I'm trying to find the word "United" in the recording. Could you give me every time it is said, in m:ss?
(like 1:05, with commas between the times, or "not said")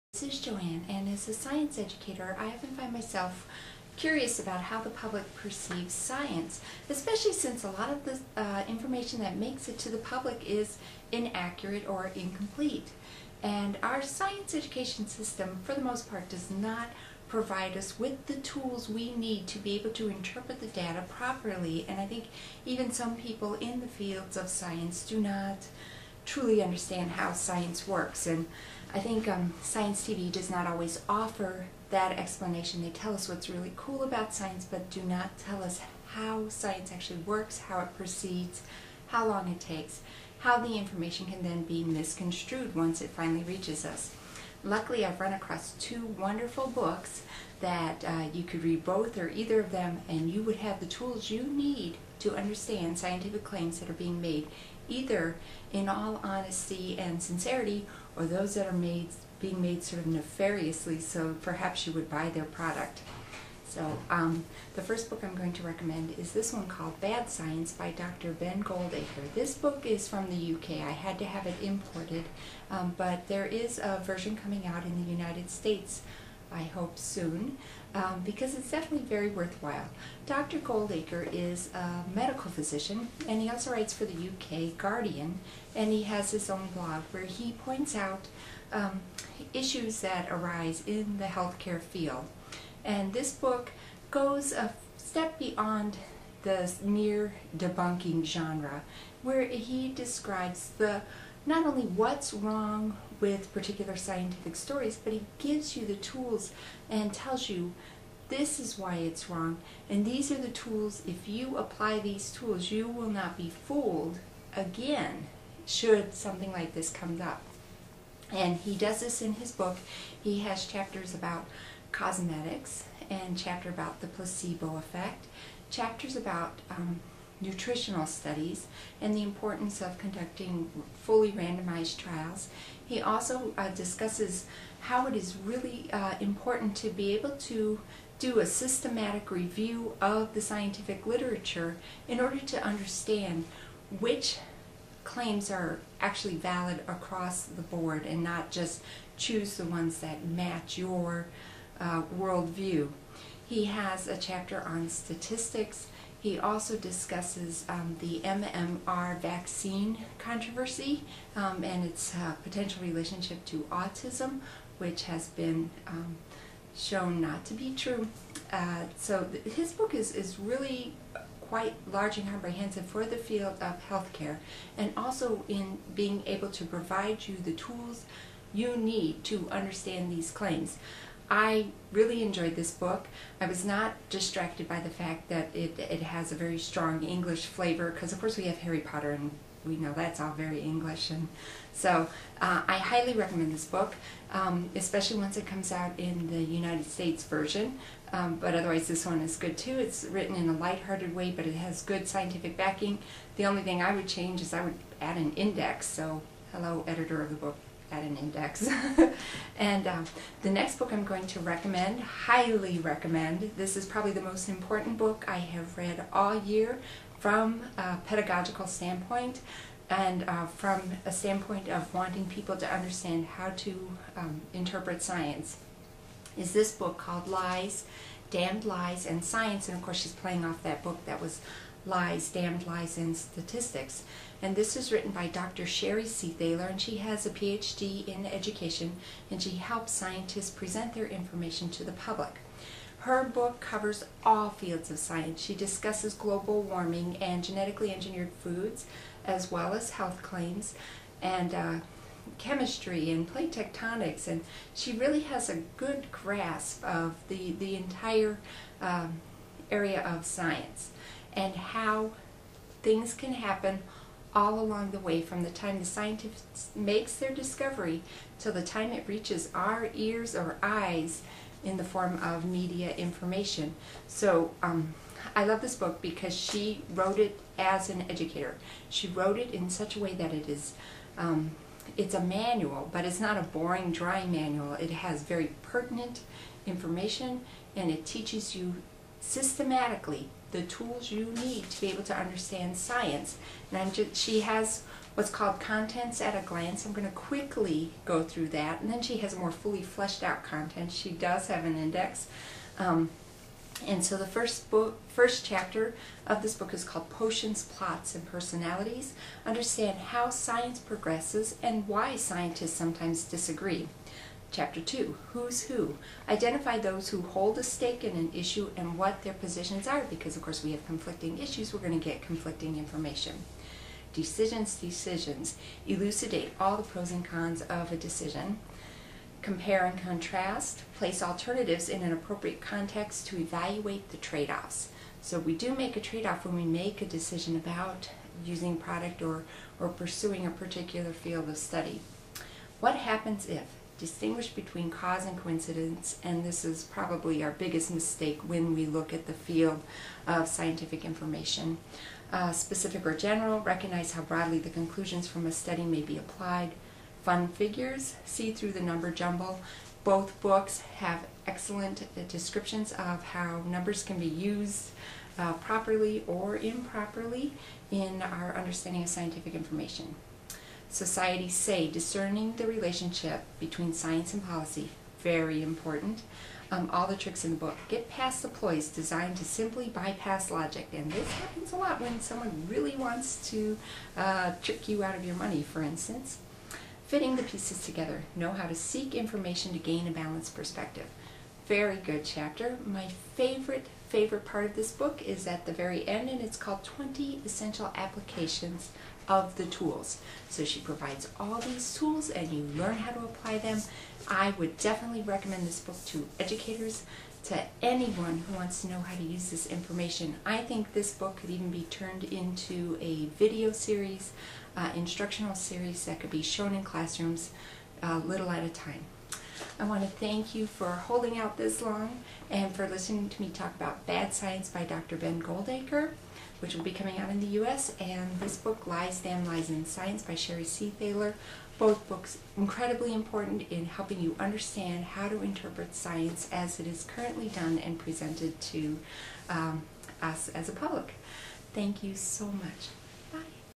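1:15, 3:16.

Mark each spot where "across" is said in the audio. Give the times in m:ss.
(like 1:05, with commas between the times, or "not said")
0:45, 2:26.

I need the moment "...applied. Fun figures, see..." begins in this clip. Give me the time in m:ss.
5:56.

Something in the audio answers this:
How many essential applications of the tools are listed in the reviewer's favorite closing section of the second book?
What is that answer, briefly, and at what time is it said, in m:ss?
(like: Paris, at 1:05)
20, at 6:36.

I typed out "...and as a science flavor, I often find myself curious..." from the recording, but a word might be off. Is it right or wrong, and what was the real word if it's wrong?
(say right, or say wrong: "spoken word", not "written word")
wrong: "educator", not "flavor".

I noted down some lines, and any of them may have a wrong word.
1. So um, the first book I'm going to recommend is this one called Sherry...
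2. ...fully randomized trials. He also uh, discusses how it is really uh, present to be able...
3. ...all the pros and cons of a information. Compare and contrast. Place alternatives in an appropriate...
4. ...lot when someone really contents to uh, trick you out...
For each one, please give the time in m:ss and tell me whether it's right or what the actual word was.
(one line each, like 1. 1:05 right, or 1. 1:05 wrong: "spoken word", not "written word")
1. 1:03 wrong: "Bad", not "Sherry"
2. 2:11 wrong: "important", not "present"
3. 5:26 wrong: "decision", not "information"
4. 6:21 wrong: "wants", not "contents".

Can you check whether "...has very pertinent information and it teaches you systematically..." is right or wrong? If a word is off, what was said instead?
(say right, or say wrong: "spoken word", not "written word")
right.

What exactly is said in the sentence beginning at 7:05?
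Ben Goldacre which will be coming out in the U.S., and this book, Lies, Damn Lies, and Science by Sherry Seethaler.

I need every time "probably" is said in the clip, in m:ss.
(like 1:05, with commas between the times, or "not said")
3:33, 5:46.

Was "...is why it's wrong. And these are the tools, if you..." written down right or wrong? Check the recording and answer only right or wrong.
right.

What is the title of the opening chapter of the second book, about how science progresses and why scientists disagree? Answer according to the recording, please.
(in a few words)
Potions, Plots, and Personalities.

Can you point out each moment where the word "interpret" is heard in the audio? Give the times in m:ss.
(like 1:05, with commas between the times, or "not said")
0:20, 3:44, 7:15.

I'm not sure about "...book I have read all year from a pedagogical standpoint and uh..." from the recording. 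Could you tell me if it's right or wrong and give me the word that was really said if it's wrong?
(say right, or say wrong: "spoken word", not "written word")
right.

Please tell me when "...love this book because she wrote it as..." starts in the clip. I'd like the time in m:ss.
4:35.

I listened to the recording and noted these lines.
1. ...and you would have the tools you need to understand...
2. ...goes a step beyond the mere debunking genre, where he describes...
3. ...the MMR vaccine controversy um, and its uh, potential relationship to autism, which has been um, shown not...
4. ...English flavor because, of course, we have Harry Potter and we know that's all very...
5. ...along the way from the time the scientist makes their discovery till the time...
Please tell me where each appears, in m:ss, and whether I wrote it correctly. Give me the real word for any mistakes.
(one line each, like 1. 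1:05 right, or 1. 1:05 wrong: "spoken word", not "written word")
1. 0:50 right
2. 1:34 right
3. 2:37 right
4. 3:07 right
5. 4:24 right.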